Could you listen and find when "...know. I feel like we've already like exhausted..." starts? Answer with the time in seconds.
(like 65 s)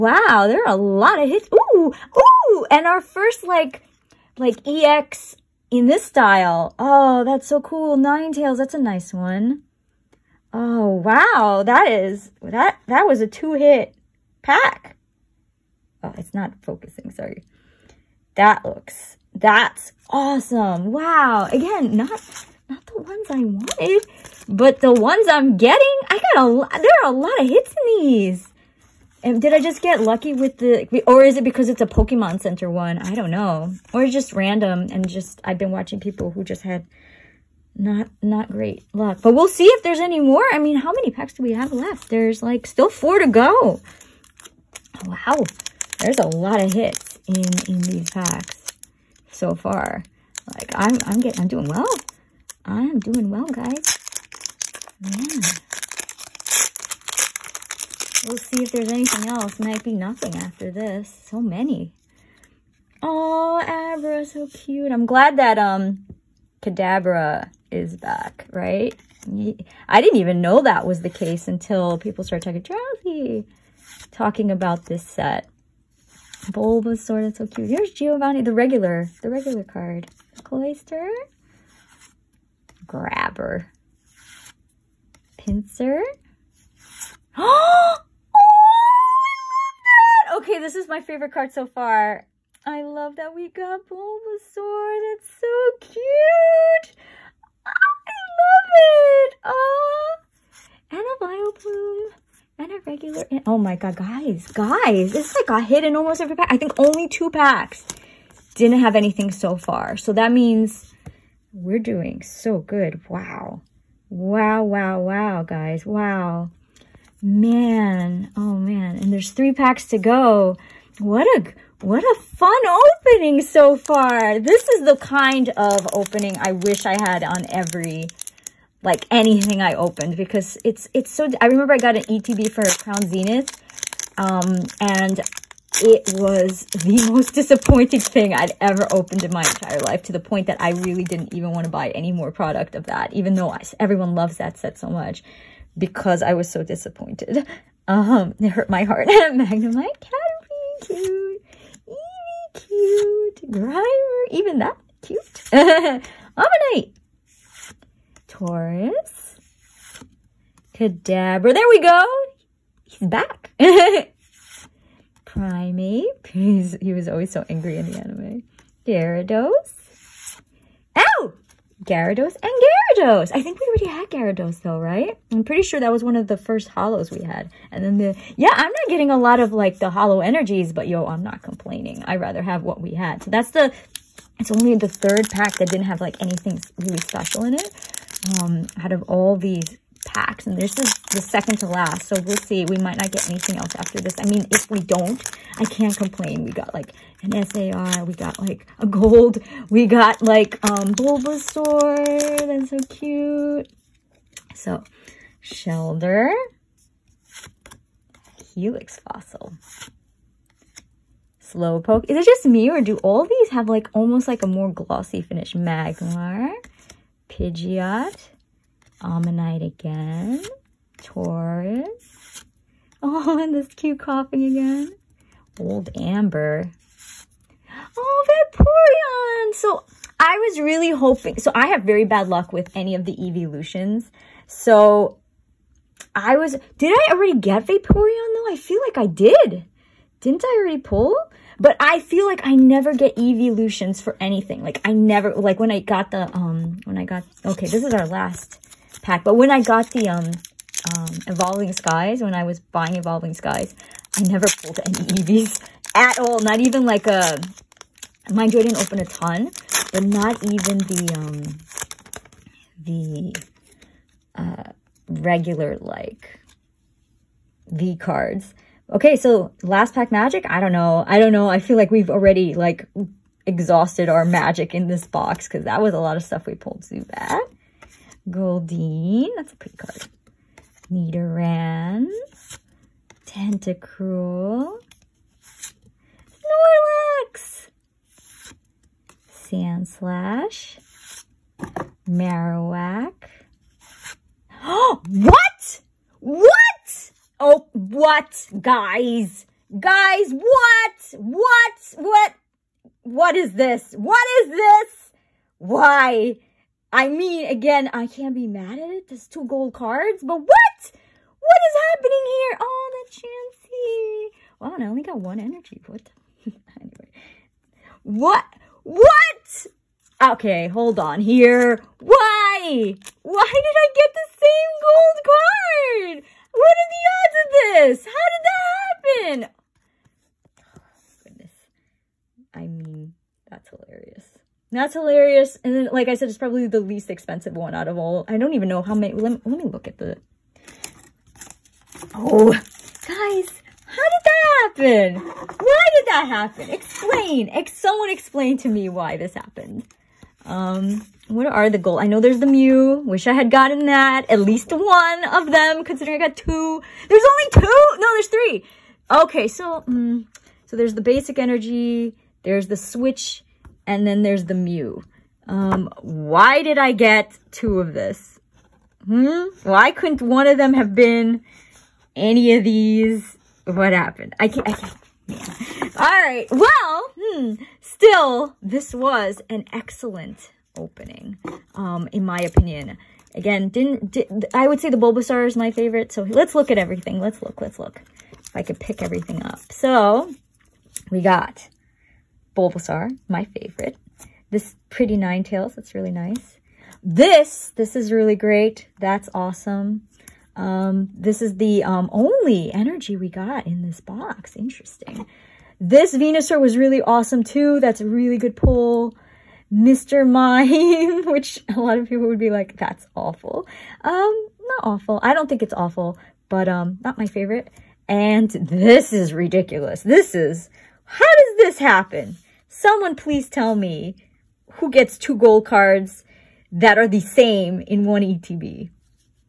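271 s.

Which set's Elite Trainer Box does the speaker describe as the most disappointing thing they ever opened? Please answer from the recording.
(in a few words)
Crown Zenith.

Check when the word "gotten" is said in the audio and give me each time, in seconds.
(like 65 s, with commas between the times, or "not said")
353 s.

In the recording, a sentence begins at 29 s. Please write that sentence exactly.
And did I just get lucky with the, or is it because it's a Pokemon Center one?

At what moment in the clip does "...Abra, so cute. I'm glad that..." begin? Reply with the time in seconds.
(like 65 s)
63 s.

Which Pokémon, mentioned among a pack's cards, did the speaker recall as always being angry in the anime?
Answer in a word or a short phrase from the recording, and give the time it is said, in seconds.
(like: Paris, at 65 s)
Primeape, at 165 s.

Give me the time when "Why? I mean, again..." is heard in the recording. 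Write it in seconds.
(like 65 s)
305 s.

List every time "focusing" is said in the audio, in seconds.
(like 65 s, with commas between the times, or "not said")
16 s.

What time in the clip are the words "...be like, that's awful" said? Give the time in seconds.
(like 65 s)
412 s.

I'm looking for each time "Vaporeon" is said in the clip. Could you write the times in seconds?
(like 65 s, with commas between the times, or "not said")
228 s, 237 s.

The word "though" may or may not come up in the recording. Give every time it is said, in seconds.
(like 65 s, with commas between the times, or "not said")
143 s, 174 s, 238 s.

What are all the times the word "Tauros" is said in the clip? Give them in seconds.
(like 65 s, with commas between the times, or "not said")
158 s, 220 s.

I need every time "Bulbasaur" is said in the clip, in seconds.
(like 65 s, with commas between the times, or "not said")
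76 s, 93 s, 200 s, 384 s, 392 s.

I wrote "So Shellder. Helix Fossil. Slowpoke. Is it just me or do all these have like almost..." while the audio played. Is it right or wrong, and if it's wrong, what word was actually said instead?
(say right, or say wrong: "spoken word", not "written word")
right.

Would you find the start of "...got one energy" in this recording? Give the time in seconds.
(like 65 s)
315 s.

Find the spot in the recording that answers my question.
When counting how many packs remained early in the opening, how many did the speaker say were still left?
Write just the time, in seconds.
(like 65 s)
42 s.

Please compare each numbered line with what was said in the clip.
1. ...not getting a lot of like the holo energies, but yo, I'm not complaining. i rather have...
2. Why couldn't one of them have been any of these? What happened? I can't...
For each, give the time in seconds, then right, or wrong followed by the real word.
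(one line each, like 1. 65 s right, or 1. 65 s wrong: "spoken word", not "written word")
1. 178 s right
2. 369 s right.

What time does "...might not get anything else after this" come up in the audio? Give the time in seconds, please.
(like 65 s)
192 s.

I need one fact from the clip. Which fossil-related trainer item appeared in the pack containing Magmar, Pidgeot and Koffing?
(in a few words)
Old Amber.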